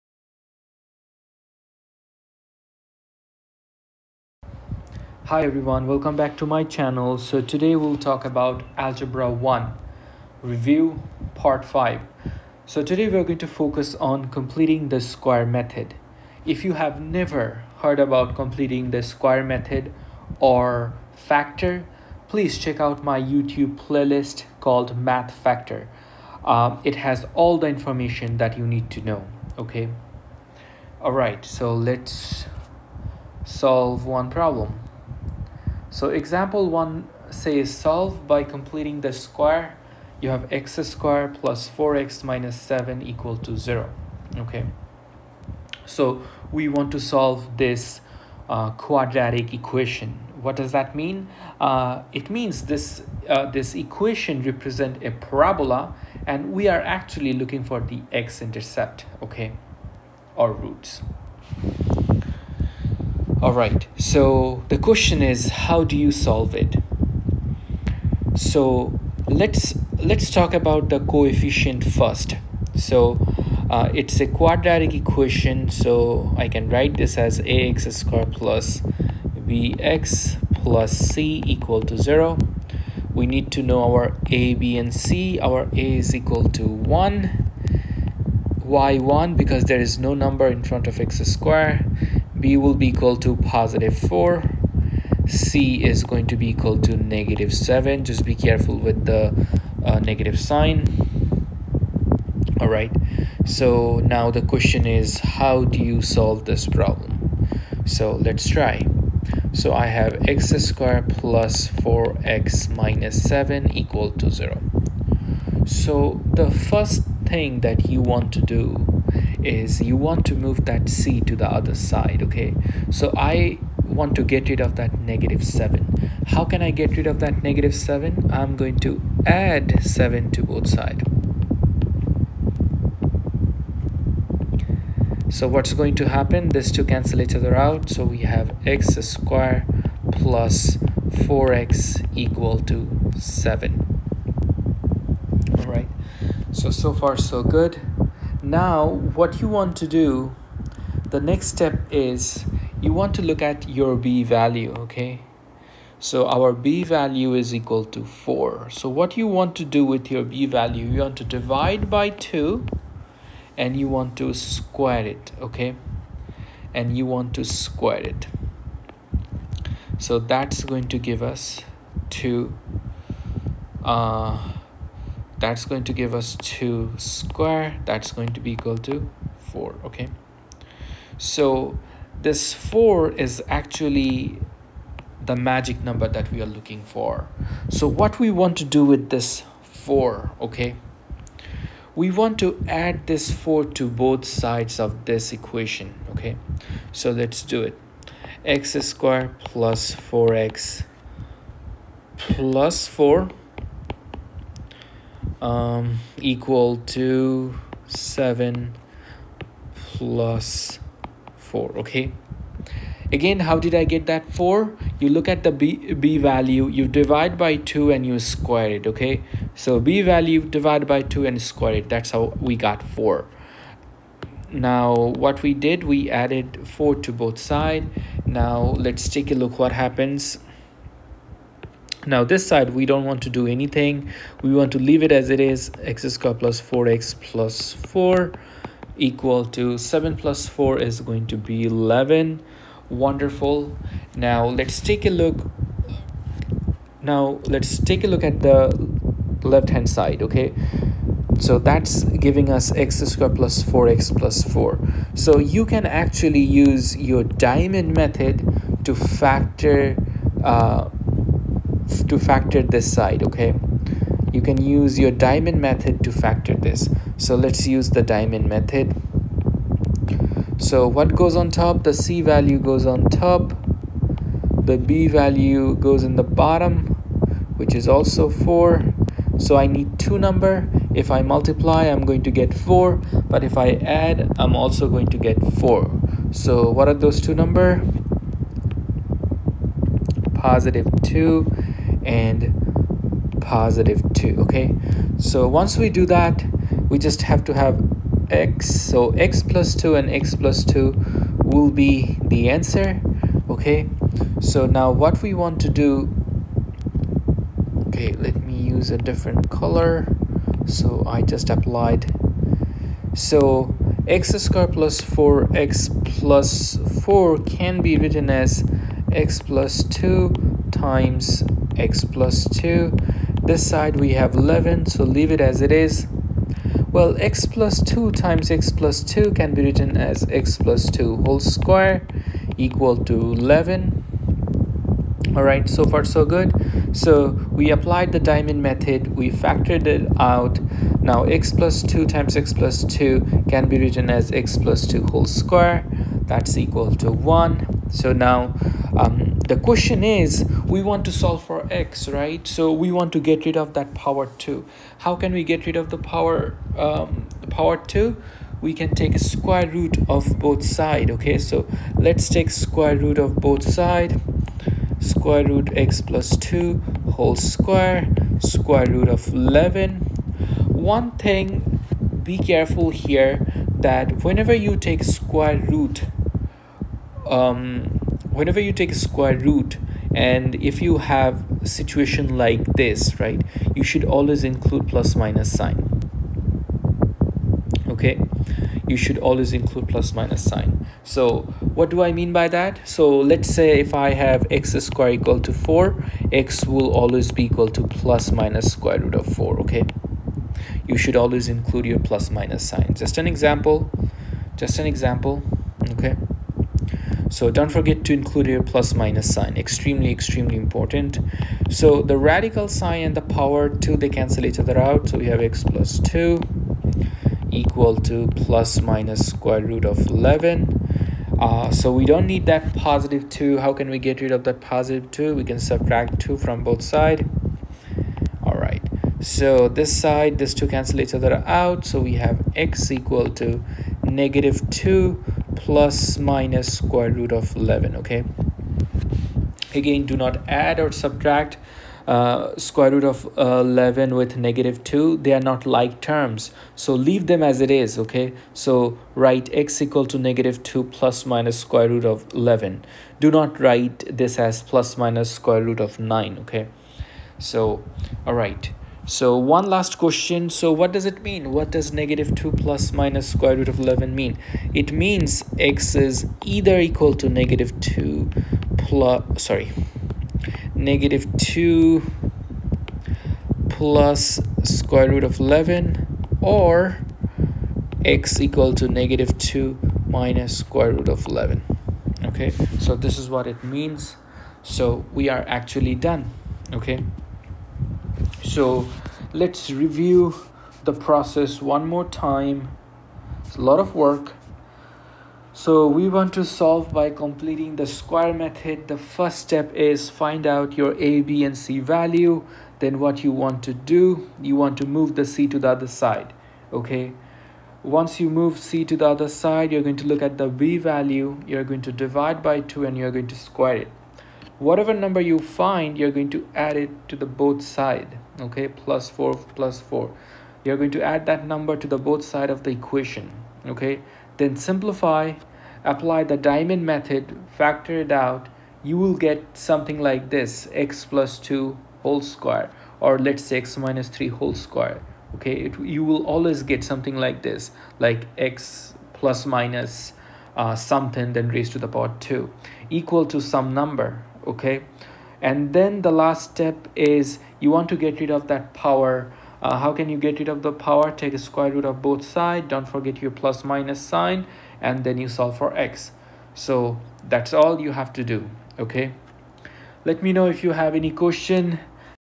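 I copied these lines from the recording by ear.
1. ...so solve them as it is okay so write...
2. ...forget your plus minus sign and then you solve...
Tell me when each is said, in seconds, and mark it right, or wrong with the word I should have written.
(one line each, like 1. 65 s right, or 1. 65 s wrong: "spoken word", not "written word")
1. 446 s wrong: "leave", not "solve"
2. 552 s right.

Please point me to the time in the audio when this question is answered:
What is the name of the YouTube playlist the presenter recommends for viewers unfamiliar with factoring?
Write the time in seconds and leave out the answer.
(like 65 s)
24 s.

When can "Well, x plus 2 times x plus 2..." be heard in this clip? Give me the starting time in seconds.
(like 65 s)
326 s.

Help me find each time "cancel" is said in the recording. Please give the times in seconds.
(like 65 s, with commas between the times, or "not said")
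136 s, 414 s, 430 s.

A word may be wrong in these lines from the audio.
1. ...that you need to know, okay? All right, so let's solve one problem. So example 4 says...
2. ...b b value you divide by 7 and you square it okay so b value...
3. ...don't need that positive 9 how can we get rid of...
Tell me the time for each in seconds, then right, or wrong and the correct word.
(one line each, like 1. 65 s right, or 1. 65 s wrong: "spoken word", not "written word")
1. 28 s wrong: "1", not "4"
2. 215 s wrong: "2", not "7"
3. 422 s wrong: "2", not "9".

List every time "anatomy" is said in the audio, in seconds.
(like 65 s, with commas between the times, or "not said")
not said.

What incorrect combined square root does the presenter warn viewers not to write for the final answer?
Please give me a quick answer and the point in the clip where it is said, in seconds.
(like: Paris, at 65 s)
plus minus square root of 9, at 454 s.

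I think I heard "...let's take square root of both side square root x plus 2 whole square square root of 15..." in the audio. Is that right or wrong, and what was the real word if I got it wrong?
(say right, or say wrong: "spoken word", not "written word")
wrong: "11", not "15".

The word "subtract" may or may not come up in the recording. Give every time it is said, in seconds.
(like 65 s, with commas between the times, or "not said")
425 s, 440 s.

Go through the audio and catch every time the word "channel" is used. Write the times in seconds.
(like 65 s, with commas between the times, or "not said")
6 s.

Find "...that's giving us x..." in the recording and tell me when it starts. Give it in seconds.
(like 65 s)
251 s.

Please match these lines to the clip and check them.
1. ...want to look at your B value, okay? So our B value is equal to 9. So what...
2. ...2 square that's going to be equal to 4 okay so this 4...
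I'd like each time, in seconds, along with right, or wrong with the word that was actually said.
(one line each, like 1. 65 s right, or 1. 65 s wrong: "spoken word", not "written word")
1. 152 s wrong: "4", not "9"
2. 176 s right.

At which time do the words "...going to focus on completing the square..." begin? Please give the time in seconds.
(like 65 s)
13 s.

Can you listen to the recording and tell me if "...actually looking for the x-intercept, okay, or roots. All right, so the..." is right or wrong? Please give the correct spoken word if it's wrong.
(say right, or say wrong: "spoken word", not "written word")
right.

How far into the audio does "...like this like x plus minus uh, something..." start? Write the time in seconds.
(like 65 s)
537 s.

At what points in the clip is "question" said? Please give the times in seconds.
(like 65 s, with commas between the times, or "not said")
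64 s, 104 s, 349 s, 459 s, 561 s.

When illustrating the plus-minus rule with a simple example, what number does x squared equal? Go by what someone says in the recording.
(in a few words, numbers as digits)
4.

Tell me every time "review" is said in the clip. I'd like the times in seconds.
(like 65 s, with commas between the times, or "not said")
10 s, 489 s.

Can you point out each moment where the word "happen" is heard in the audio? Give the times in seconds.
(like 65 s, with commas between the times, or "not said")
136 s, 229 s.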